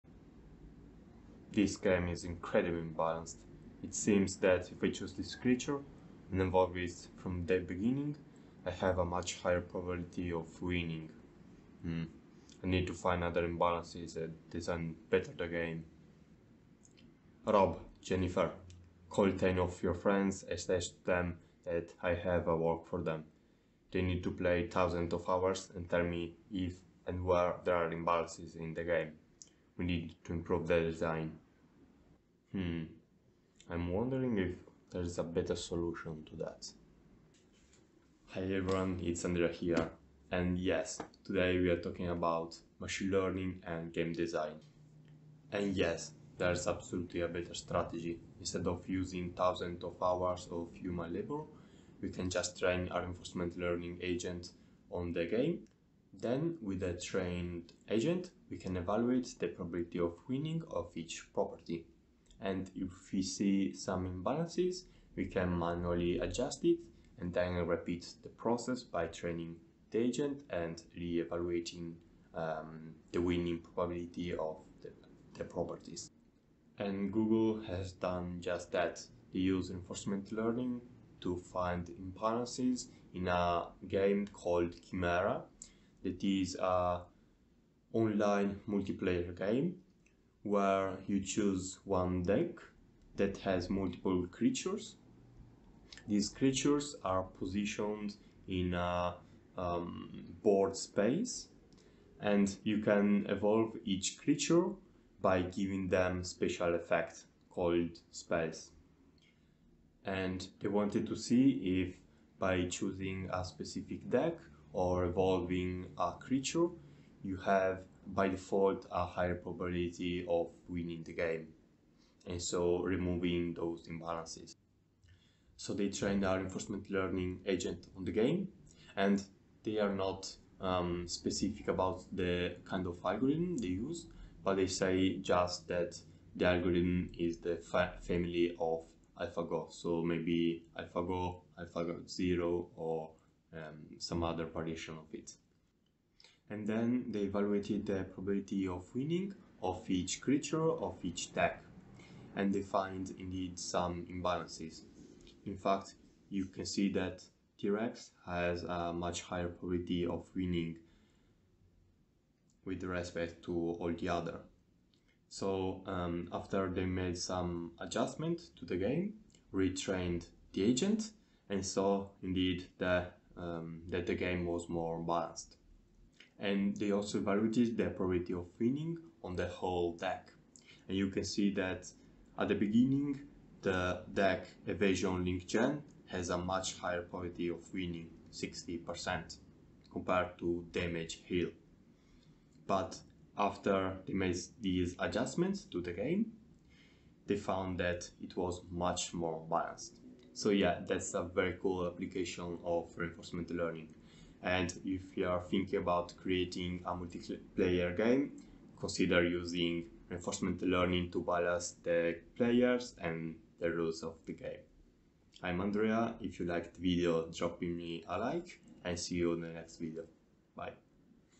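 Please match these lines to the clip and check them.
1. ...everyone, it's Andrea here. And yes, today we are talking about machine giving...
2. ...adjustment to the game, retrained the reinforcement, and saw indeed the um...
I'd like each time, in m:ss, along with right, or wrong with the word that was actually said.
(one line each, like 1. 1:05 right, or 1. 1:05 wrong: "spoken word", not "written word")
1. 0:38 wrong: "learning", not "giving"
2. 2:47 wrong: "agent", not "reinforcement".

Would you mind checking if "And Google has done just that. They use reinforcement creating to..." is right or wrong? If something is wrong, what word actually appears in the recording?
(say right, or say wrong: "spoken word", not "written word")
wrong: "learning", not "creating".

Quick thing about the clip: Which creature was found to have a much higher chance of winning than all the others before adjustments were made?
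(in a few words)
T-Rex.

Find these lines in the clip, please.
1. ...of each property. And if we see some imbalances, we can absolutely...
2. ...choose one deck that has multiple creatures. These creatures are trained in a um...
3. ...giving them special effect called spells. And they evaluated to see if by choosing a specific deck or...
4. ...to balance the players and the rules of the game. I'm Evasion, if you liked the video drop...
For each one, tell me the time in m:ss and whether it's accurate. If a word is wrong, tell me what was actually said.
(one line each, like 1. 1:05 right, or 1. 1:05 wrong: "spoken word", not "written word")
1. 1:00 wrong: "manually", not "absolutely"
2. 1:31 wrong: "positioned", not "trained"
3. 1:45 wrong: "wanted", not "evaluated"
4. 3:31 wrong: "Andrea", not "Evasion".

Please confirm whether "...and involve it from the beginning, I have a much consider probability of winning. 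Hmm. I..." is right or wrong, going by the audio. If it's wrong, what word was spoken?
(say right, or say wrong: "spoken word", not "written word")
wrong: "higher", not "consider".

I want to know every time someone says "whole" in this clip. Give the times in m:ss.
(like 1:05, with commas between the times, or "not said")
2:59.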